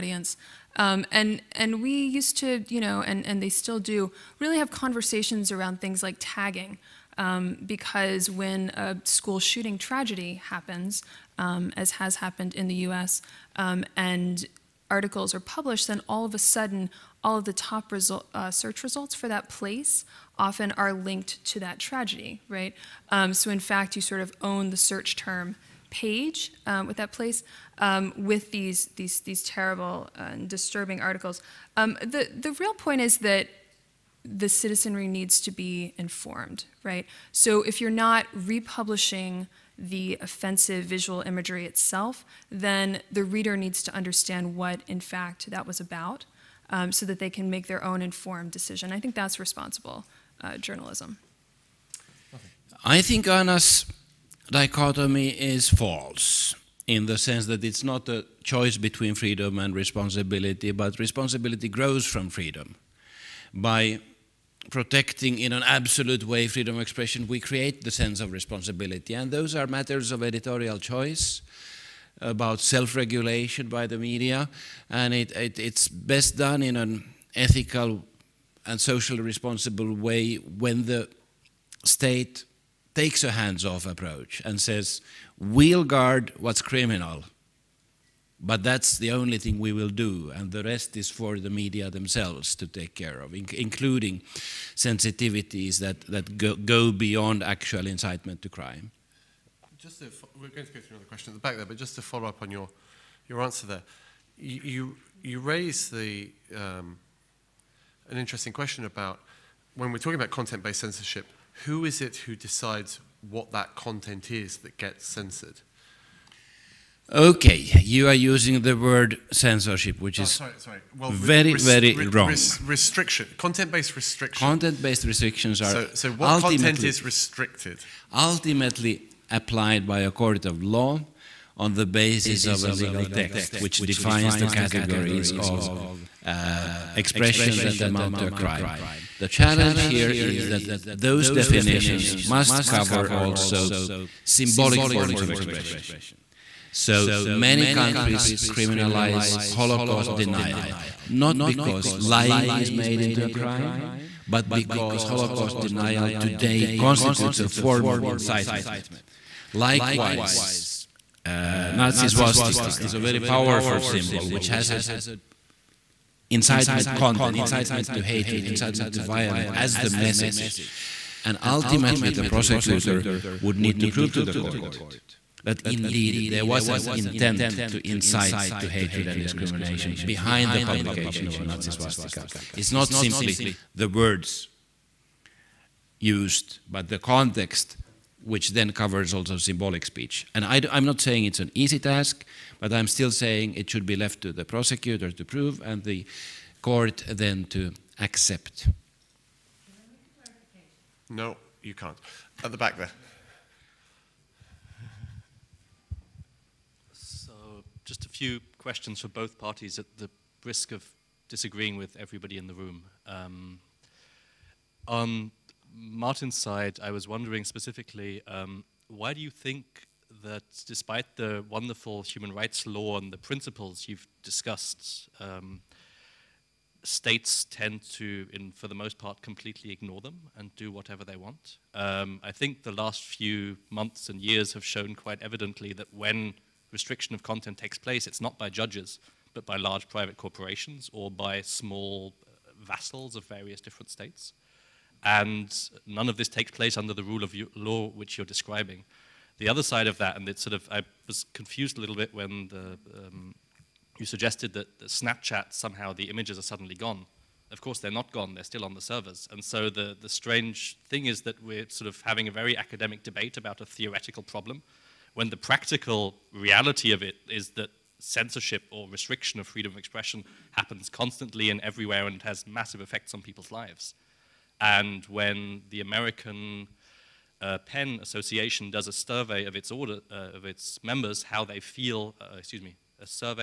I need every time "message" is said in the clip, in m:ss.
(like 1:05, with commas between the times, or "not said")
2:49.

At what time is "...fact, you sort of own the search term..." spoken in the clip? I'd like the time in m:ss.
0:23.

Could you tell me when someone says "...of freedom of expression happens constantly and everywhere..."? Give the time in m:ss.
4:29.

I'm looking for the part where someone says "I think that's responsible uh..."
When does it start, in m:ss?
0:48.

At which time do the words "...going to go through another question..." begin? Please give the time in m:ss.
1:40.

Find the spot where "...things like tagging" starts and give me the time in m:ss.
0:05.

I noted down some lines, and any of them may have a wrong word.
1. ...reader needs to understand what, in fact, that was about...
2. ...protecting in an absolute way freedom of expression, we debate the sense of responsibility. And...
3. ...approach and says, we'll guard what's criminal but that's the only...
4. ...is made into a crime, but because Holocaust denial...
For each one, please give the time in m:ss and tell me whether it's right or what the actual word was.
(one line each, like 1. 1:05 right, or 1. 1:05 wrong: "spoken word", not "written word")
1. 0:43 right
2. 1:04 wrong: "create", not "debate"
3. 1:23 right
4. 2:32 right.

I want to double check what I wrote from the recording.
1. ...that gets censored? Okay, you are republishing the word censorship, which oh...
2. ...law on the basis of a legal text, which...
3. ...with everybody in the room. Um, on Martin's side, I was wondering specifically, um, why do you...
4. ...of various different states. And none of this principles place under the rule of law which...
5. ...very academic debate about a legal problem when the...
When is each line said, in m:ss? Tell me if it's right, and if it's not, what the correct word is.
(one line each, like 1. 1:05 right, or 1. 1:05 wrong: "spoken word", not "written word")
1. 1:54 wrong: "using", not "republishing"
2. 2:10 right
3. 3:31 right
4. 4:03 wrong: "takes", not "principles"
5. 4:22 wrong: "theoretical", not "legal".